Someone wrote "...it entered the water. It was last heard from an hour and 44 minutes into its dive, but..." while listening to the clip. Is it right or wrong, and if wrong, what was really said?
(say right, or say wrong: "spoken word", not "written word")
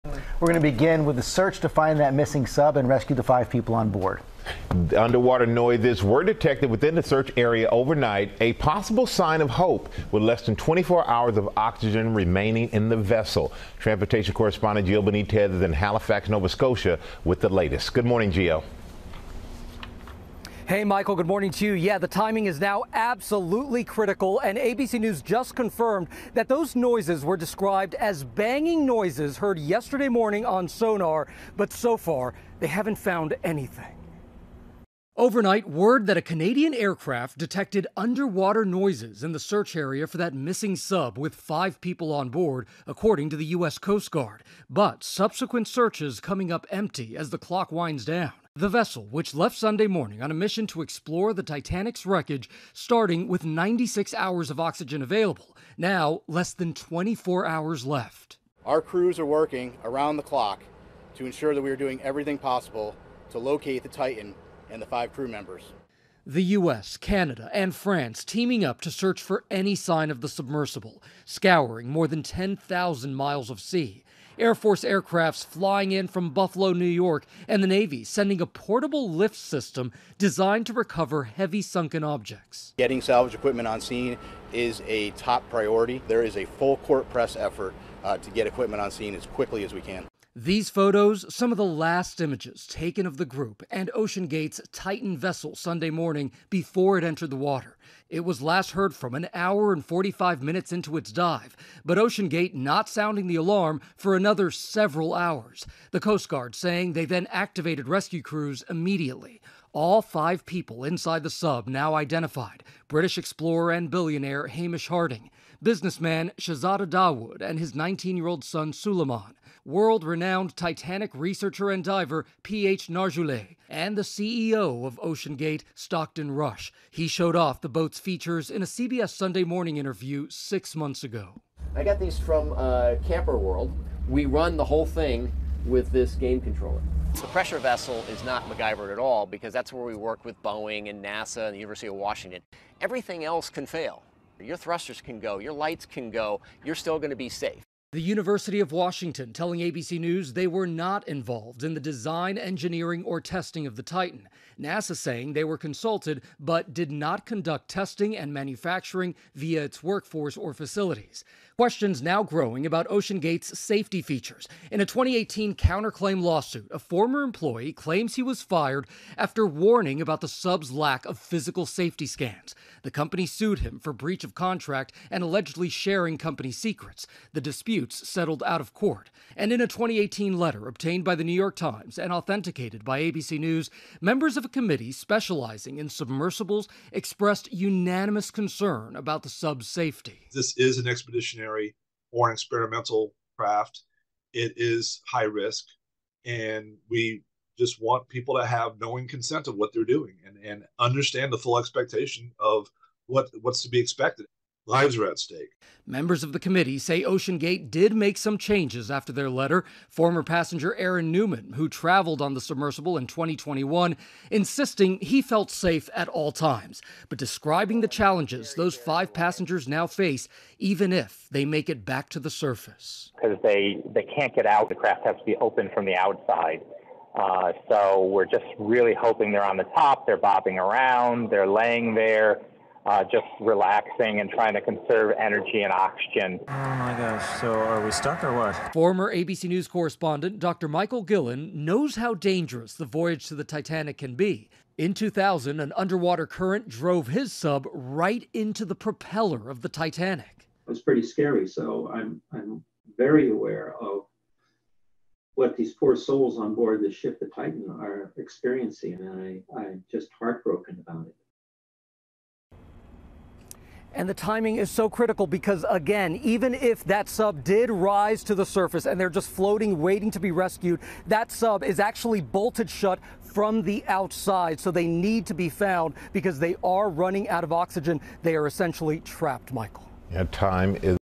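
wrong: "45", not "44".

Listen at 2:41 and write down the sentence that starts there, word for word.
Questions now growing about OceanGate's safety features.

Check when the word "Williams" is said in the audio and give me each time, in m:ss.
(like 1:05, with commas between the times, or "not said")
not said.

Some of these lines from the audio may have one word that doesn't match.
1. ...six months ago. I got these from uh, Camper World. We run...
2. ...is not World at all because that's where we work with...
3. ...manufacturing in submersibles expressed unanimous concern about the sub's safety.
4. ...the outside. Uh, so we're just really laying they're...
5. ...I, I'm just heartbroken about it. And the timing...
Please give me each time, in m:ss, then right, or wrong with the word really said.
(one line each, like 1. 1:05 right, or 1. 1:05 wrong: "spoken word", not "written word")
1. 2:10 right
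2. 2:18 wrong: "MacGyver", not "World"
3. 3:04 wrong: "specializing", not "manufacturing"
4. 3:45 wrong: "hoping", not "laying"
5. 4:19 right.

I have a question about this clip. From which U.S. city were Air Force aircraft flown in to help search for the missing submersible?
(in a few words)
Buffalo, New York.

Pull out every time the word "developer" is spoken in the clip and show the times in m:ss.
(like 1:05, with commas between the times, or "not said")
not said.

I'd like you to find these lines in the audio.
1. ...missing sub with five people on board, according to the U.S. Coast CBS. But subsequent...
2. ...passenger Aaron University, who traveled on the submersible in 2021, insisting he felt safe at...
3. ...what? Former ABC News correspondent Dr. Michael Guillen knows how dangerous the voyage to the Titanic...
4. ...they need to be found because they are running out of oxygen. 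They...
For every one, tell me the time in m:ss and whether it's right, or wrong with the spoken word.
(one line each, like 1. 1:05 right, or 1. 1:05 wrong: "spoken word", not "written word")
1. 0:40 wrong: "Guard", not "CBS"
2. 3:30 wrong: "Newman", not "University"
3. 3:58 right
4. 4:34 right.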